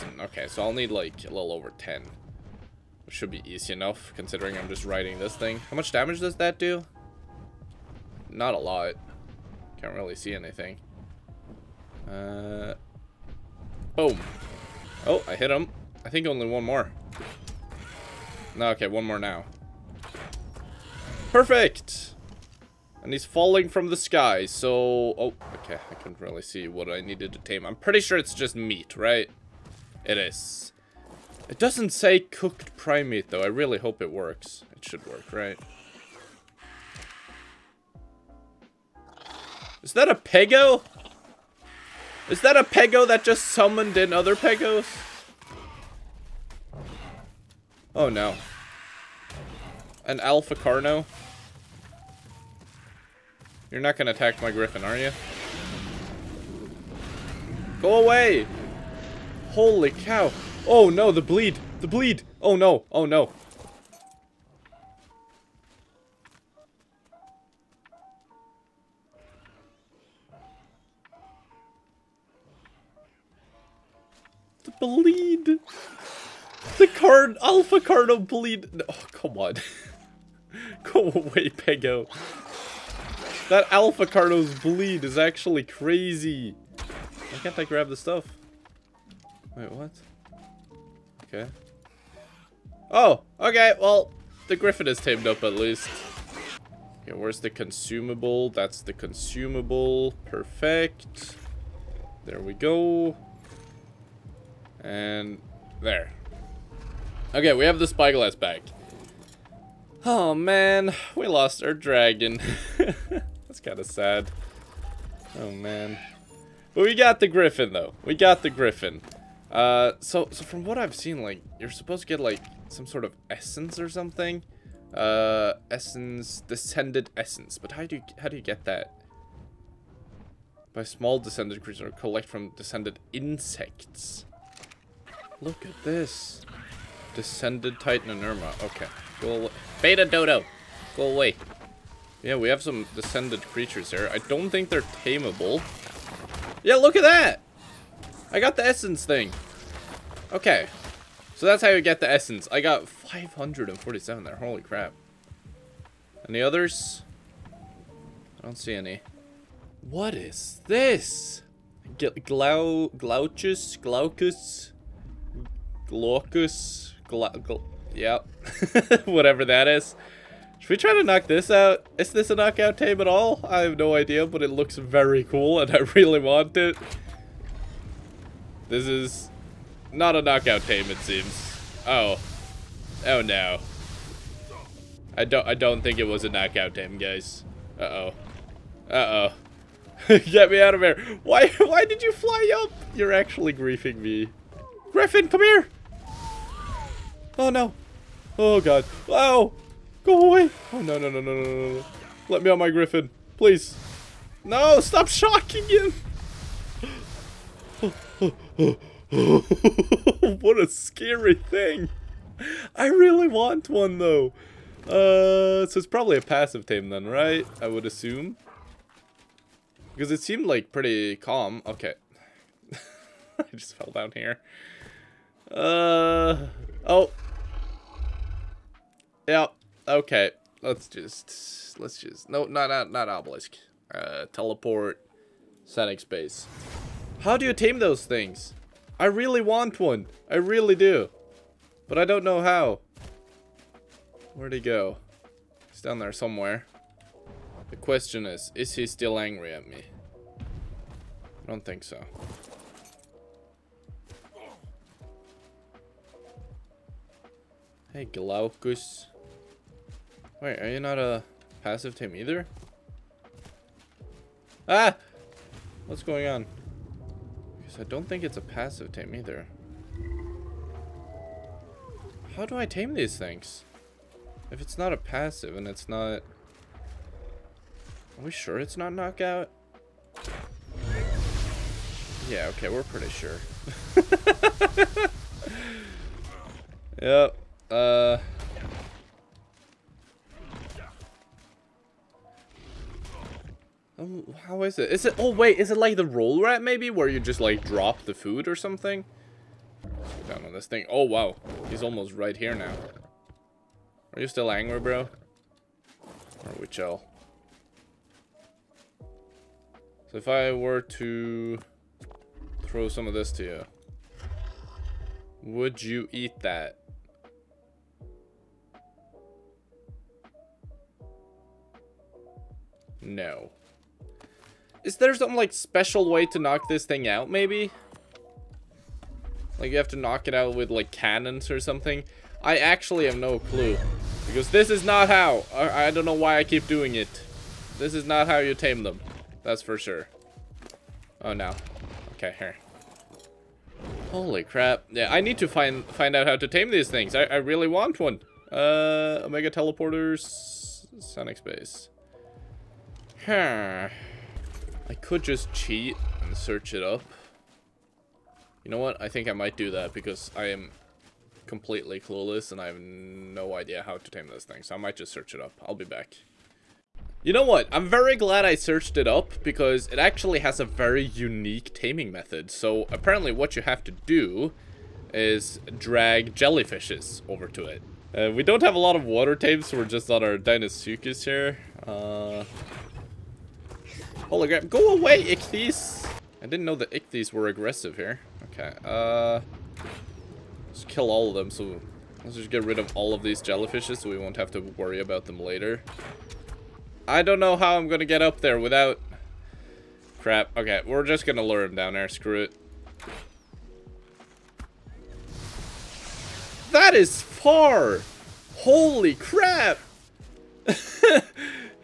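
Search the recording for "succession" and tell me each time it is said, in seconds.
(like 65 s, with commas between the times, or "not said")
not said.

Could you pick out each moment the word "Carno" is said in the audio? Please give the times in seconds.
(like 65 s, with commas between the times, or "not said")
50 s, 77 s, 84 s.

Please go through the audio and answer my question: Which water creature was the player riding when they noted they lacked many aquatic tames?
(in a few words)
Deinosuchus.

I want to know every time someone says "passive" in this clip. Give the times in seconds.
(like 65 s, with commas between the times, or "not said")
216 s, 261 s, 268 s, 274 s.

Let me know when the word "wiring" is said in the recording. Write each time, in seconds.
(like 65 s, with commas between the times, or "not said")
not said.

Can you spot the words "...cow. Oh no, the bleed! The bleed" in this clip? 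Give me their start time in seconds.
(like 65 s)
59 s.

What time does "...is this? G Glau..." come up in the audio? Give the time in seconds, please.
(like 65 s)
160 s.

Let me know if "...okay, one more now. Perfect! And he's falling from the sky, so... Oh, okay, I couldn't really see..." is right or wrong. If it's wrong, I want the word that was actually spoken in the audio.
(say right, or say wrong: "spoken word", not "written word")
right.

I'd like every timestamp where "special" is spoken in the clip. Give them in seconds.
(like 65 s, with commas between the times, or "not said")
325 s.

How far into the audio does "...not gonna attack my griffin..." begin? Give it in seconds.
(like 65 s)
53 s.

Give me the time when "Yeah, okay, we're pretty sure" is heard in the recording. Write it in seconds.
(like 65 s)
282 s.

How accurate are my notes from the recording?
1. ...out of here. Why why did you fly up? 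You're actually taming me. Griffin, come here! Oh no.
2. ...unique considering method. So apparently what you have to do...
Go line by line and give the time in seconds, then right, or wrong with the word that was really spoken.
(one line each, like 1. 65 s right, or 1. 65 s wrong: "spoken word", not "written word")
1. 190 s wrong: "griefing", not "taming"
2. 371 s wrong: "taming", not "considering".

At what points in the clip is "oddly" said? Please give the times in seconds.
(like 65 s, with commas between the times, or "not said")
not said.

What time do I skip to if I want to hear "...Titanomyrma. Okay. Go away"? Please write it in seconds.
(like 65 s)
137 s.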